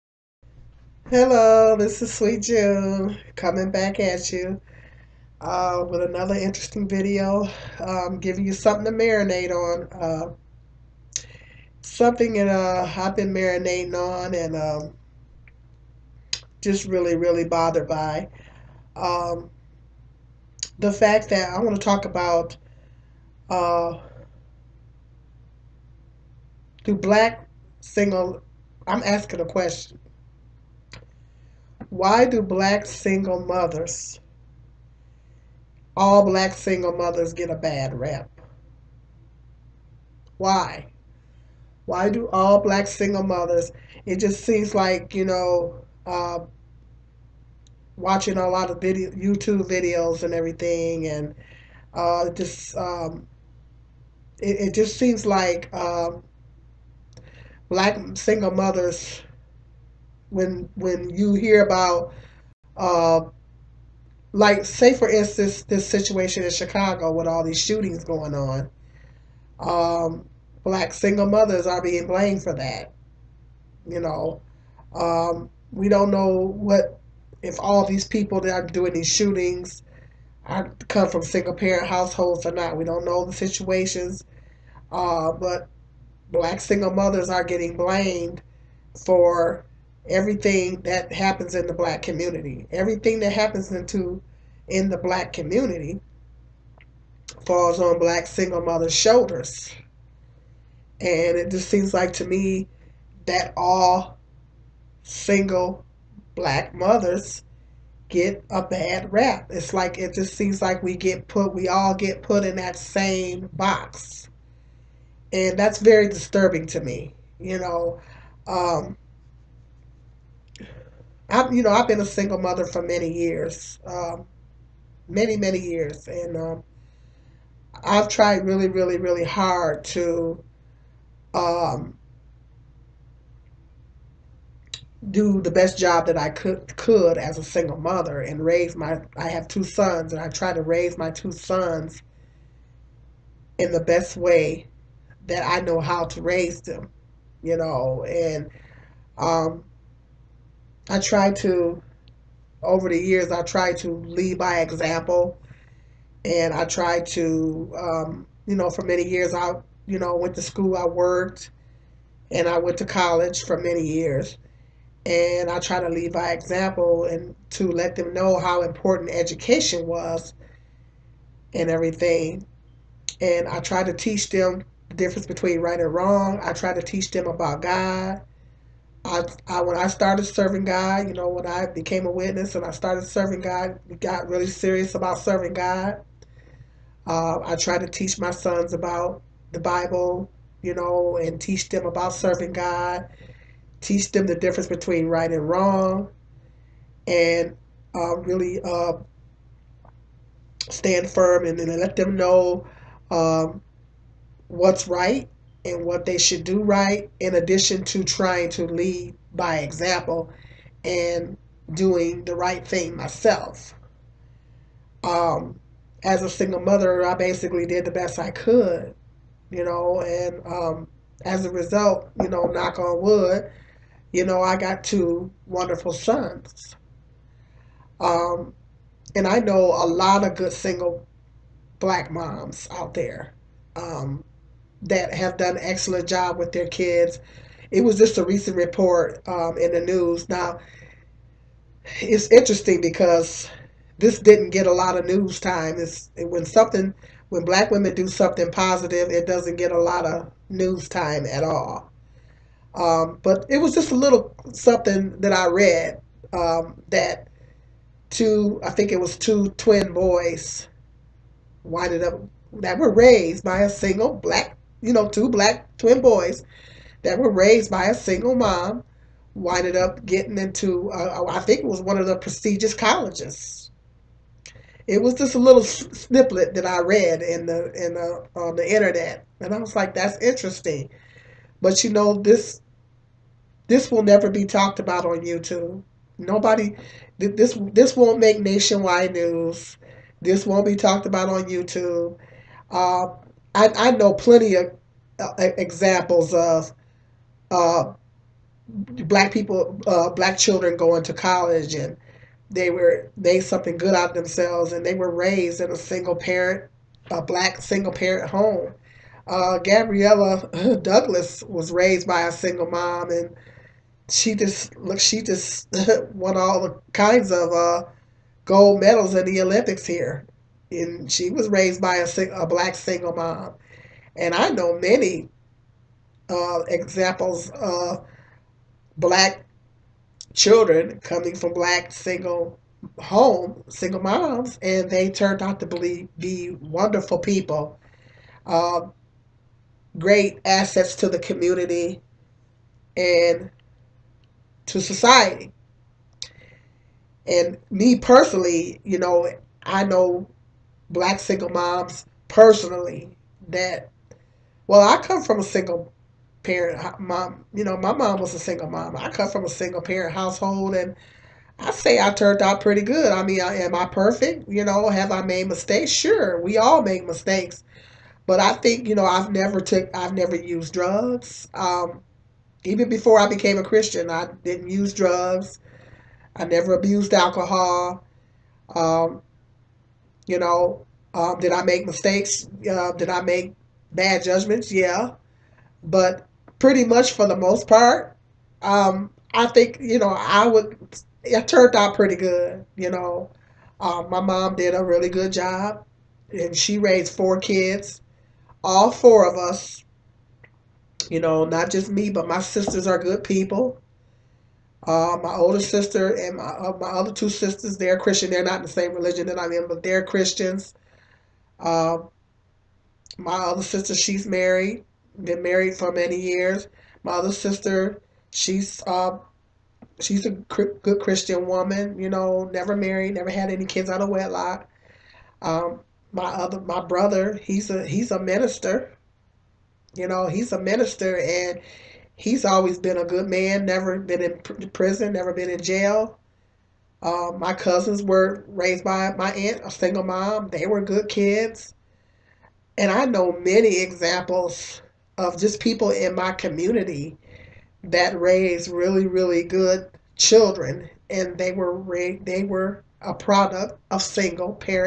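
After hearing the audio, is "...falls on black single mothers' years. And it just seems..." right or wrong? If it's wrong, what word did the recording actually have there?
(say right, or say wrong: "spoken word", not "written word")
wrong: "shoulders", not "years".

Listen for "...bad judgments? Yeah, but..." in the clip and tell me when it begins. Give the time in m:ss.
6:23.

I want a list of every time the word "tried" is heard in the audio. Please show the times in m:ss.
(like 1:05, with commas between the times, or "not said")
2:08, 3:07.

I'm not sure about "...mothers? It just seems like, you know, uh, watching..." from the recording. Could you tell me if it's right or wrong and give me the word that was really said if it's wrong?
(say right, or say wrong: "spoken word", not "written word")
right.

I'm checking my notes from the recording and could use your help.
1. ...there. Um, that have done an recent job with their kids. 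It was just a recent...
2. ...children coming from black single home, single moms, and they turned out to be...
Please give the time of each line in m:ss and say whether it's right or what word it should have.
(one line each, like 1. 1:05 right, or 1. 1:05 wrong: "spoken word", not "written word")
1. 3:52 wrong: "excellent", not "recent"
2. 5:30 right.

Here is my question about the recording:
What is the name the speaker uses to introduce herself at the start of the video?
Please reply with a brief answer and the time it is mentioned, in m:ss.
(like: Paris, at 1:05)
Sweet June, at 0:02.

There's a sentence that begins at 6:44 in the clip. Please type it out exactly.
Uh, my older sister and my, uh, my other two sisters, they're Christian.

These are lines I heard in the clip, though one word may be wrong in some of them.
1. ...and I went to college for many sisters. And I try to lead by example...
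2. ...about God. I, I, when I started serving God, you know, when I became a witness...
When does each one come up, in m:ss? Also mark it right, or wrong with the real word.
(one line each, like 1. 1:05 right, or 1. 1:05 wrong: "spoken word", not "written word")
1. 2:42 wrong: "years", not "sisters"
2. 2:57 right.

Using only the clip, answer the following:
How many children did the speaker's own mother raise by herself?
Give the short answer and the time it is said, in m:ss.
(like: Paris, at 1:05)
4, at 6:37.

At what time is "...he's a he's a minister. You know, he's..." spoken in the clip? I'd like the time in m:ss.
7:07.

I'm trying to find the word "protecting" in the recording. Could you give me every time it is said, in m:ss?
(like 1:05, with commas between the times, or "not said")
not said.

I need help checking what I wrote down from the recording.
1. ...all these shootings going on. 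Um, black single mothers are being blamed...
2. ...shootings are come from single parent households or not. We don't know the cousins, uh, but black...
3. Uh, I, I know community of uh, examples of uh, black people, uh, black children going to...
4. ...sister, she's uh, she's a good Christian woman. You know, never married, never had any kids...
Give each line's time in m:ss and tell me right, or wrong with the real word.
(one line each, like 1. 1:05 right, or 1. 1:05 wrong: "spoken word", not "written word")
1. 1:07 right
2. 1:19 wrong: "situations", not "cousins"
3. 4:52 wrong: "plenty", not "community"
4. 6:57 right.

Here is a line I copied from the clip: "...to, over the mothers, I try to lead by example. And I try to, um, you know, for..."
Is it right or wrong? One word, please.
wrong.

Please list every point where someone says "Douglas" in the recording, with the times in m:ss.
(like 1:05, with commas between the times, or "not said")
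5:10.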